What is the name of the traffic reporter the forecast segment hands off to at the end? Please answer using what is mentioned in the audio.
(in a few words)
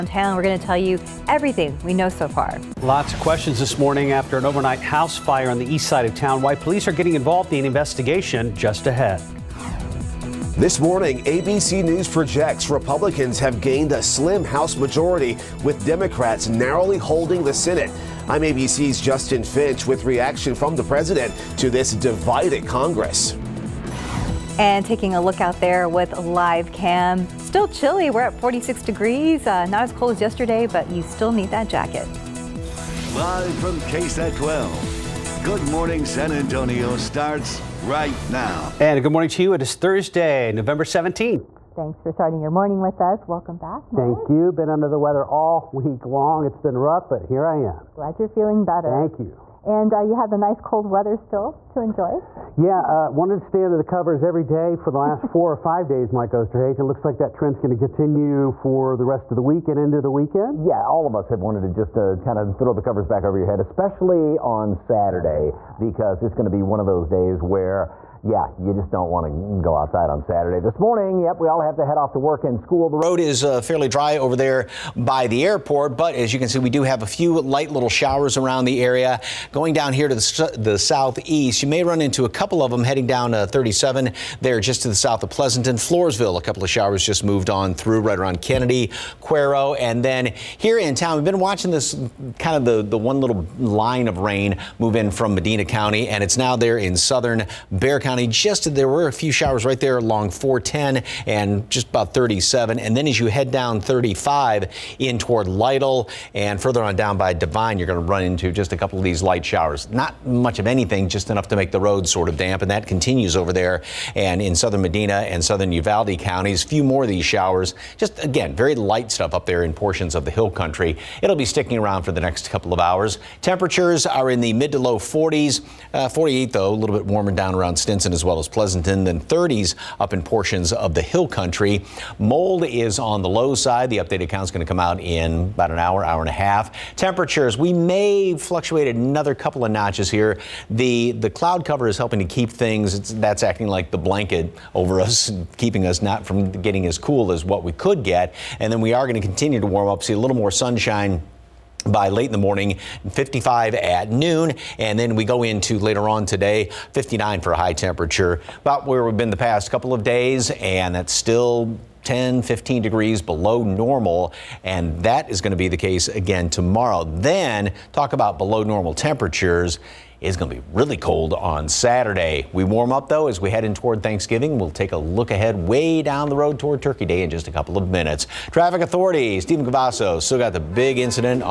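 Stephen Cavazos.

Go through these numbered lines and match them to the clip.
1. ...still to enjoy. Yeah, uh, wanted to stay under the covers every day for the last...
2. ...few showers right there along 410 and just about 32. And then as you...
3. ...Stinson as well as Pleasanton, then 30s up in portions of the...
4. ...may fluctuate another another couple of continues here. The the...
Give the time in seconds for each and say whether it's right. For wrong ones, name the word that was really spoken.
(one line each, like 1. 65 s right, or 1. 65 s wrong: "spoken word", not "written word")
1. 51 s right
2. 99 s wrong: "37", not "32"
3. 127 s right
4. 137 s wrong: "notches", not "continues".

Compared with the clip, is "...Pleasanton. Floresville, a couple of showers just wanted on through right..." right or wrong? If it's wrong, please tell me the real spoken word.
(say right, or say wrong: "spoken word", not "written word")
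wrong: "moved", not "wanted".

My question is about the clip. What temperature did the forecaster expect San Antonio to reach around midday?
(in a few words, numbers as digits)
55.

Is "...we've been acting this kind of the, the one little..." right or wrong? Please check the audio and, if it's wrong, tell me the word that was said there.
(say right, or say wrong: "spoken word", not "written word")
wrong: "watching", not "acting".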